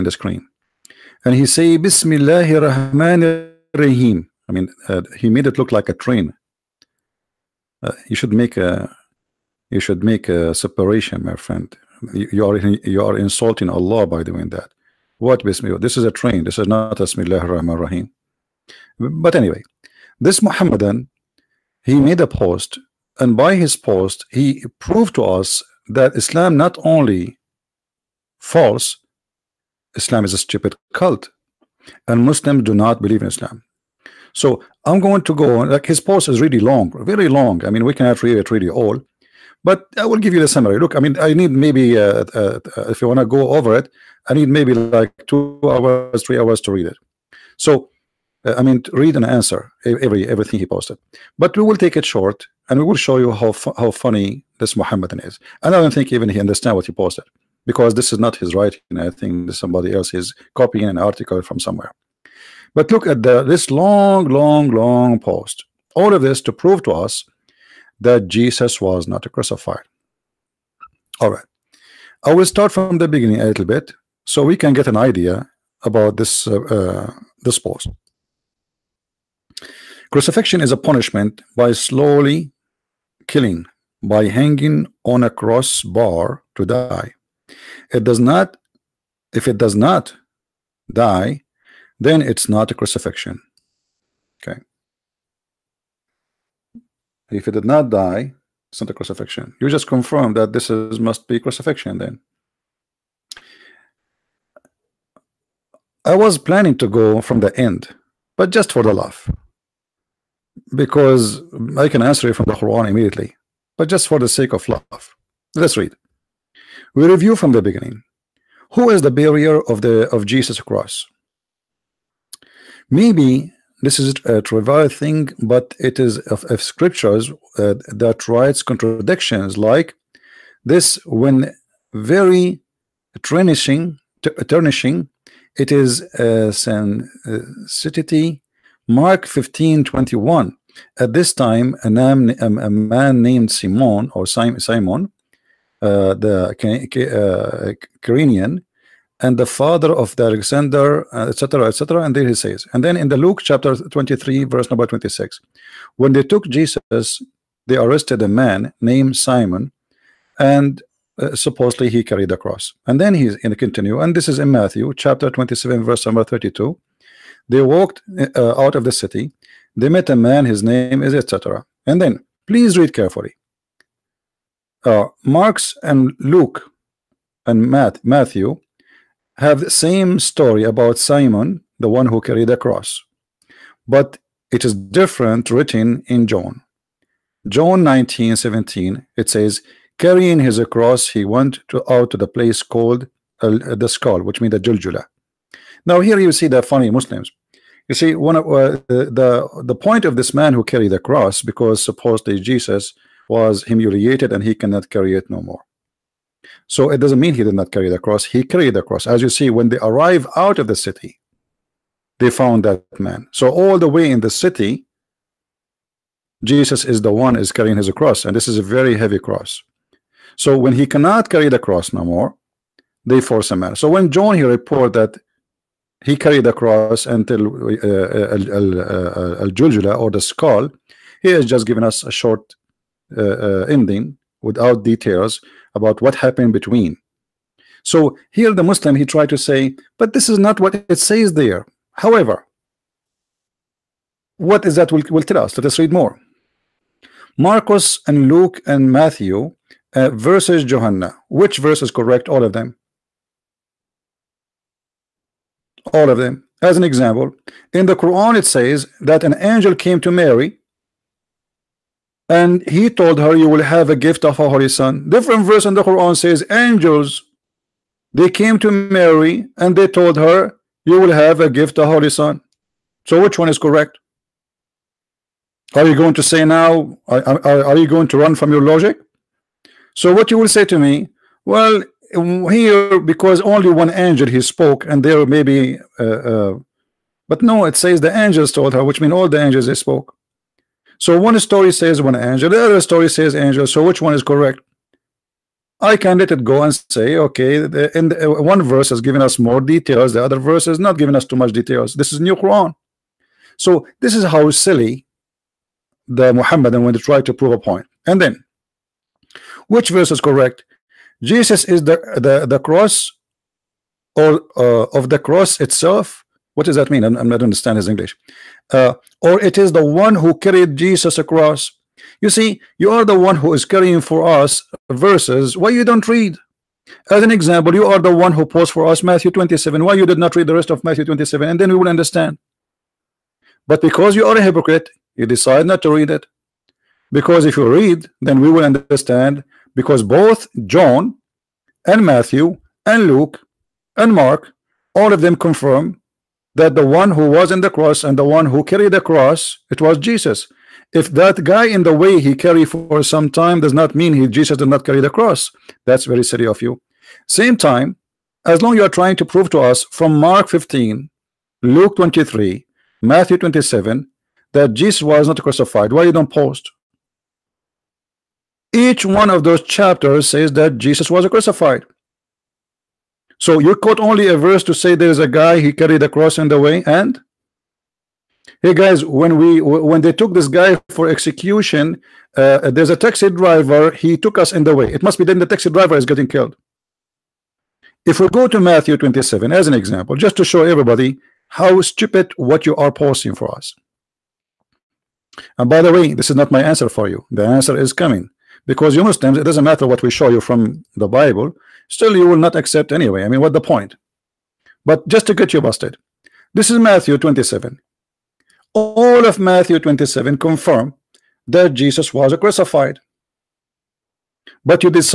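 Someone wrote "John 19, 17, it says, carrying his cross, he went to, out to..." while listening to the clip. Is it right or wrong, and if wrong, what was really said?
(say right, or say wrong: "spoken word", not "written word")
right.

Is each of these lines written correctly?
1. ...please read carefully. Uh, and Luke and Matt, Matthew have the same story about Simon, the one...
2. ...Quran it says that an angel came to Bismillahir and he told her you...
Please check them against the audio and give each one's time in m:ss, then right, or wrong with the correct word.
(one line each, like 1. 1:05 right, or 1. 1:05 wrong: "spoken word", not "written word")
1. 2:52 right
2. 4:17 wrong: "Mary", not "Bismillahir".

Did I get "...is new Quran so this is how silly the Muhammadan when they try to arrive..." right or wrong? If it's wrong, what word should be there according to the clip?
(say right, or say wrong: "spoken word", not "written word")
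wrong: "prove", not "arrive".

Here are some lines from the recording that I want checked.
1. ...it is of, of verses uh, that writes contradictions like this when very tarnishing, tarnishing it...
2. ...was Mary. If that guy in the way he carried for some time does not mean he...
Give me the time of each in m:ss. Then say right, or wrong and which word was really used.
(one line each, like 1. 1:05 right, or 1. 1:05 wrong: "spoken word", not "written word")
1. 2:05 wrong: "scriptures", not "verses"
2. 5:49 wrong: "Jesus", not "Mary".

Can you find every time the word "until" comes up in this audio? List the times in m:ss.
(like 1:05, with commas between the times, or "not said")
3:47.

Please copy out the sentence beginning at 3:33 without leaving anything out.
So all the way in the city, Jesus is the one is carrying his cross, and this is a very heavy cross.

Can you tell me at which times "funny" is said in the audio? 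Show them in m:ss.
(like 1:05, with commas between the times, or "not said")
0:54, 3:16.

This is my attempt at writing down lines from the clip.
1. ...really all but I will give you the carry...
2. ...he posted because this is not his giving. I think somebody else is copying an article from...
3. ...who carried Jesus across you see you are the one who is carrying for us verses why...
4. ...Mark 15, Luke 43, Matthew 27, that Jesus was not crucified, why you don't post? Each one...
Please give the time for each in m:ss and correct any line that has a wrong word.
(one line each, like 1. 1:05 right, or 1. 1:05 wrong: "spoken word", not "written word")
1. 0:38 wrong: "summary", not "carry"
2. 0:56 wrong: "writing", not "giving"
3. 5:20 right
4. 6:00 wrong: "23", not "43".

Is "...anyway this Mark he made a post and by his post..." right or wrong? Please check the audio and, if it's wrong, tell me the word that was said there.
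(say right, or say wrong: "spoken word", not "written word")
wrong: "Muhammadan", not "Mark".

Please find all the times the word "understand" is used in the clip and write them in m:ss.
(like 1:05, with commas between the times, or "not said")
0:56, 5:17, 5:31, 5:38.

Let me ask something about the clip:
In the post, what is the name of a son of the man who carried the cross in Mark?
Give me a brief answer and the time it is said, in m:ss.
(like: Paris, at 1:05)
Alexander, at 2:30.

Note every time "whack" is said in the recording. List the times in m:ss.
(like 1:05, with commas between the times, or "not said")
not said.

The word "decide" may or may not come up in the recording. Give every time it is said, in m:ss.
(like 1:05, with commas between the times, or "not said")
5:35.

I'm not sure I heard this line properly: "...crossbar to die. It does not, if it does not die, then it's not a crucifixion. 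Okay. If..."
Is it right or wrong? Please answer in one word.
right.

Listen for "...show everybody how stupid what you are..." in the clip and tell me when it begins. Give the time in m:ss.
6:30.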